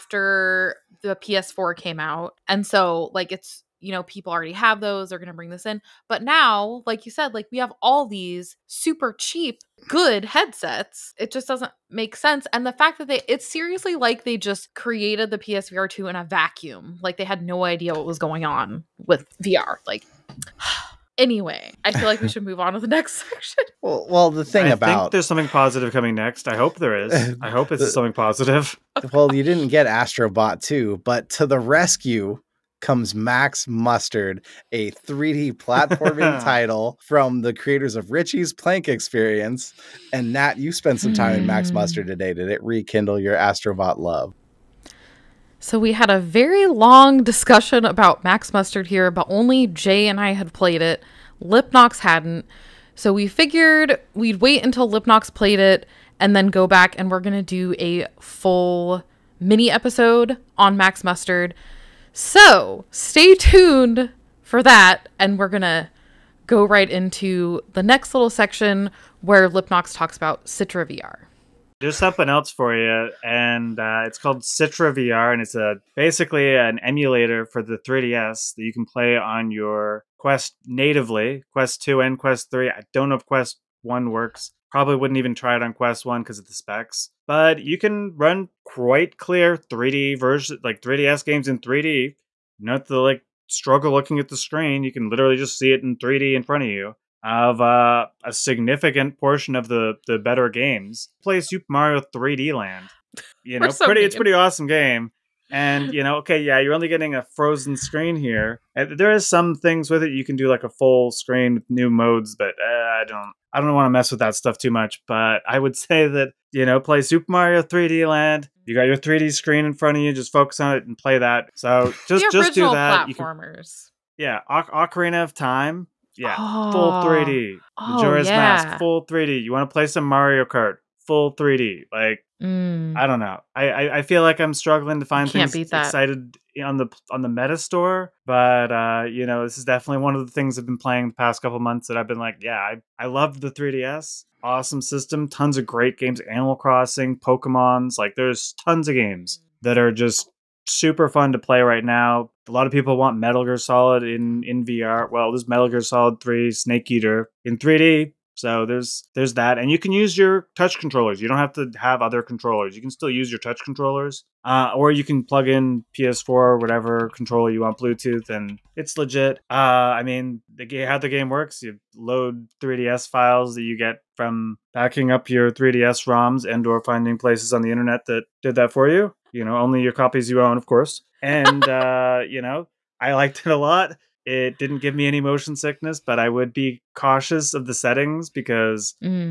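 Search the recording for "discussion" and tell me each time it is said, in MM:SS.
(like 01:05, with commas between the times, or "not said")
00:47.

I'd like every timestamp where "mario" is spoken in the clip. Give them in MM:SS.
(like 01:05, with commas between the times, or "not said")
01:41, 01:57, 02:10.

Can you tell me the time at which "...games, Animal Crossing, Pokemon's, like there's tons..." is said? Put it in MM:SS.
02:25.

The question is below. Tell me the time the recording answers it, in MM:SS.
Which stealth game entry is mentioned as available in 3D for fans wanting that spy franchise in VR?
02:35.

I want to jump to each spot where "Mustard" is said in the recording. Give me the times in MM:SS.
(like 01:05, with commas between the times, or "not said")
00:33, 00:41, 00:48, 01:01.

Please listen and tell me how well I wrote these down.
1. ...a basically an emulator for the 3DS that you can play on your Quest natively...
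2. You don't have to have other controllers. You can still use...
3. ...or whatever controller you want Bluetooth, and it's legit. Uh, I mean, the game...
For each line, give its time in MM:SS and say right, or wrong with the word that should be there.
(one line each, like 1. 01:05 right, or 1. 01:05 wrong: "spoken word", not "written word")
1. 01:15 right
2. 02:41 right
3. 02:46 right.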